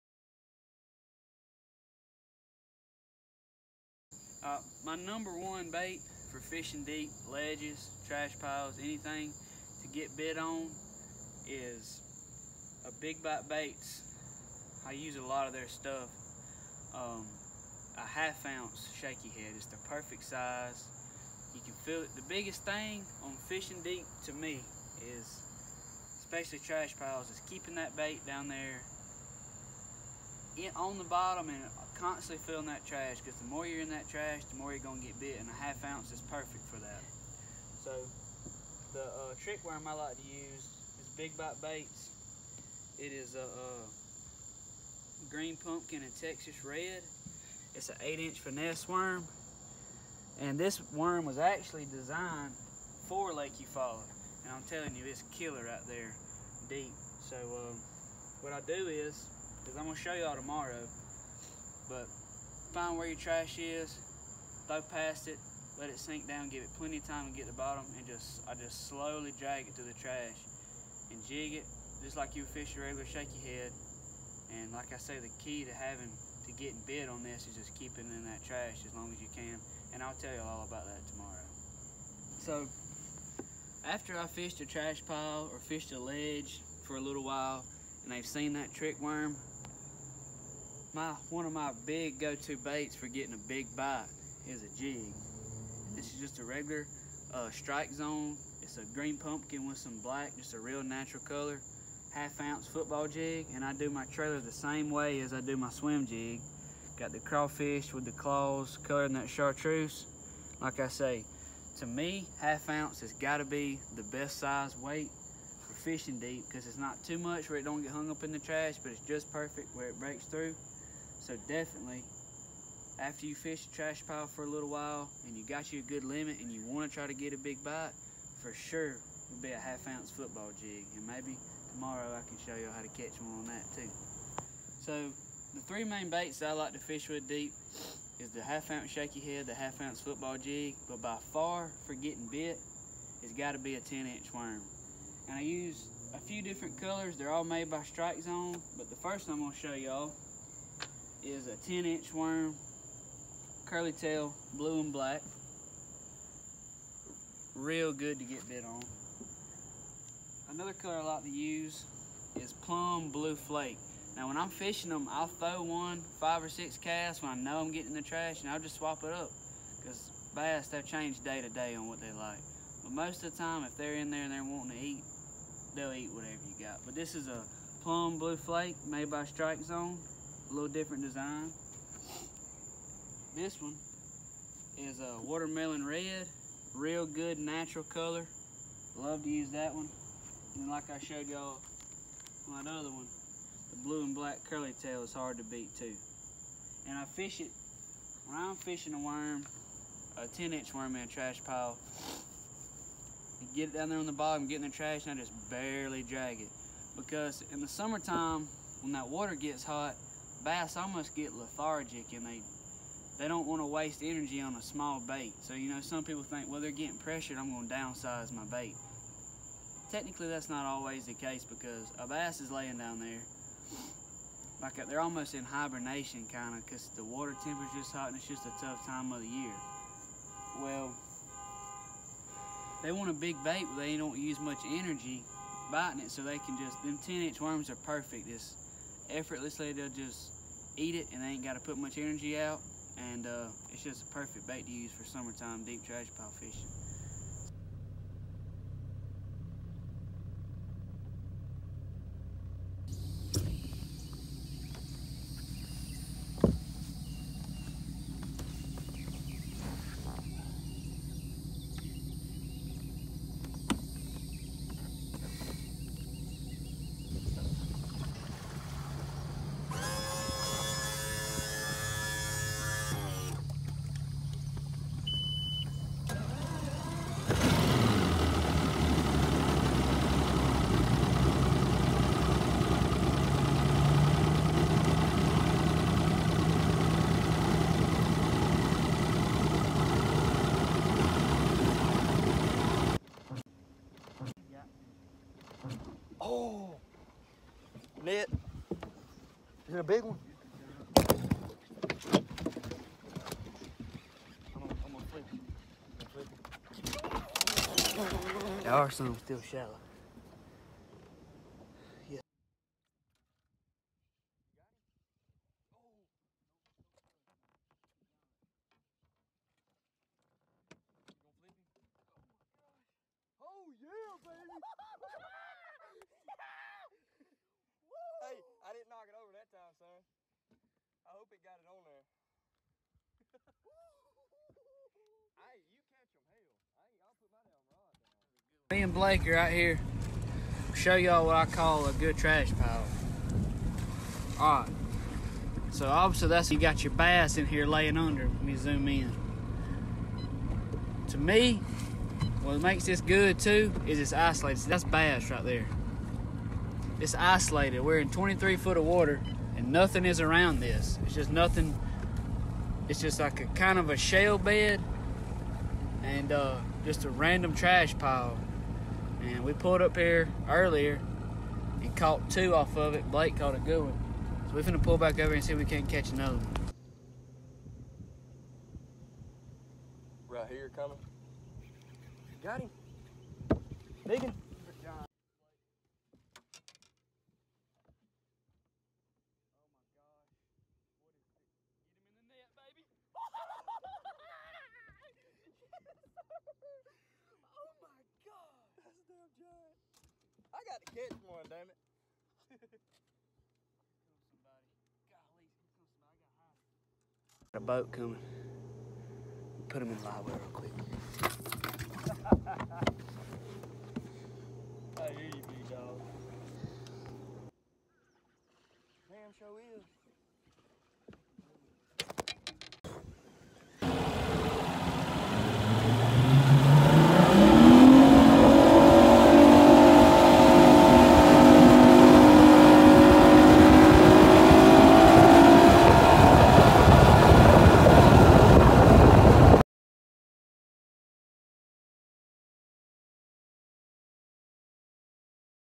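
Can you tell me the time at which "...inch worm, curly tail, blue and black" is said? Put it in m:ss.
2:31.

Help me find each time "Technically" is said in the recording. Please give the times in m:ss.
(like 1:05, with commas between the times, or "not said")
3:39.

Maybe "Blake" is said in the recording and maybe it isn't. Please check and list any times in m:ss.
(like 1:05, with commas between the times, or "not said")
5:38, 6:13.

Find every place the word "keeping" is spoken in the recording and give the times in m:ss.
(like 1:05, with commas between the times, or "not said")
0:27, 1:17.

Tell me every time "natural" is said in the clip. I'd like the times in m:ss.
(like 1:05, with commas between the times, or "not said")
1:40, 3:07.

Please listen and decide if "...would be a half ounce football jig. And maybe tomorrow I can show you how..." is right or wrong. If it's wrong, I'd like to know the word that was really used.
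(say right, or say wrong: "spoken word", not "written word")
right.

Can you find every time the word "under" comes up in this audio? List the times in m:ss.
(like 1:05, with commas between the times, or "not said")
5:47.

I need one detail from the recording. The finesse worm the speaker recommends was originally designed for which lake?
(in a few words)
Lake Eufaula.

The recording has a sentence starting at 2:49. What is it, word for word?
Cause bass, they've changed day to day on what they like.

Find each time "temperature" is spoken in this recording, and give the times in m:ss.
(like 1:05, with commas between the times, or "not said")
3:47.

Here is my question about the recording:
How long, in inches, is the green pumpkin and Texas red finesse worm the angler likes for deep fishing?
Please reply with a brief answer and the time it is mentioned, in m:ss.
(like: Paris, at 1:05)
8-inch, at 0:48.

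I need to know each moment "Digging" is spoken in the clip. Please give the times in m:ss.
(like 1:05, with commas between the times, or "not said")
6:24.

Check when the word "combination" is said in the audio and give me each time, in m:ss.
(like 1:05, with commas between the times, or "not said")
not said.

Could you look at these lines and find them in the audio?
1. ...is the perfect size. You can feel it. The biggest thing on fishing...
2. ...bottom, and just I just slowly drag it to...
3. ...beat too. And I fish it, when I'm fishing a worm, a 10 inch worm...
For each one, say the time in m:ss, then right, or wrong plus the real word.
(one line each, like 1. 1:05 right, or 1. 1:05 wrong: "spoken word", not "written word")
1. 0:19 right
2. 1:07 right
3. 3:15 right.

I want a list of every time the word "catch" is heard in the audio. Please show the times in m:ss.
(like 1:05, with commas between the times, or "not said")
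2:12, 5:35, 6:15, 6:40.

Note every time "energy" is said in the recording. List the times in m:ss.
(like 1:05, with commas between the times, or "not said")
3:34, 3:54, 4:01.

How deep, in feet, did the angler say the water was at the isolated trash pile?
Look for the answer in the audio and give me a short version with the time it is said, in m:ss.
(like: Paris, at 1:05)
23, at 5:58.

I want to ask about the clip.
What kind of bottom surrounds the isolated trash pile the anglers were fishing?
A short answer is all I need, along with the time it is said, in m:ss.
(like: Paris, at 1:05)
shale bed, at 6:03.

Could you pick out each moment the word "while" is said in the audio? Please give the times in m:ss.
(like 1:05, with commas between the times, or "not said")
1:27, 2:04.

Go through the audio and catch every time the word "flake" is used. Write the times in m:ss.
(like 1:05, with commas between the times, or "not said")
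2:43, 2:58.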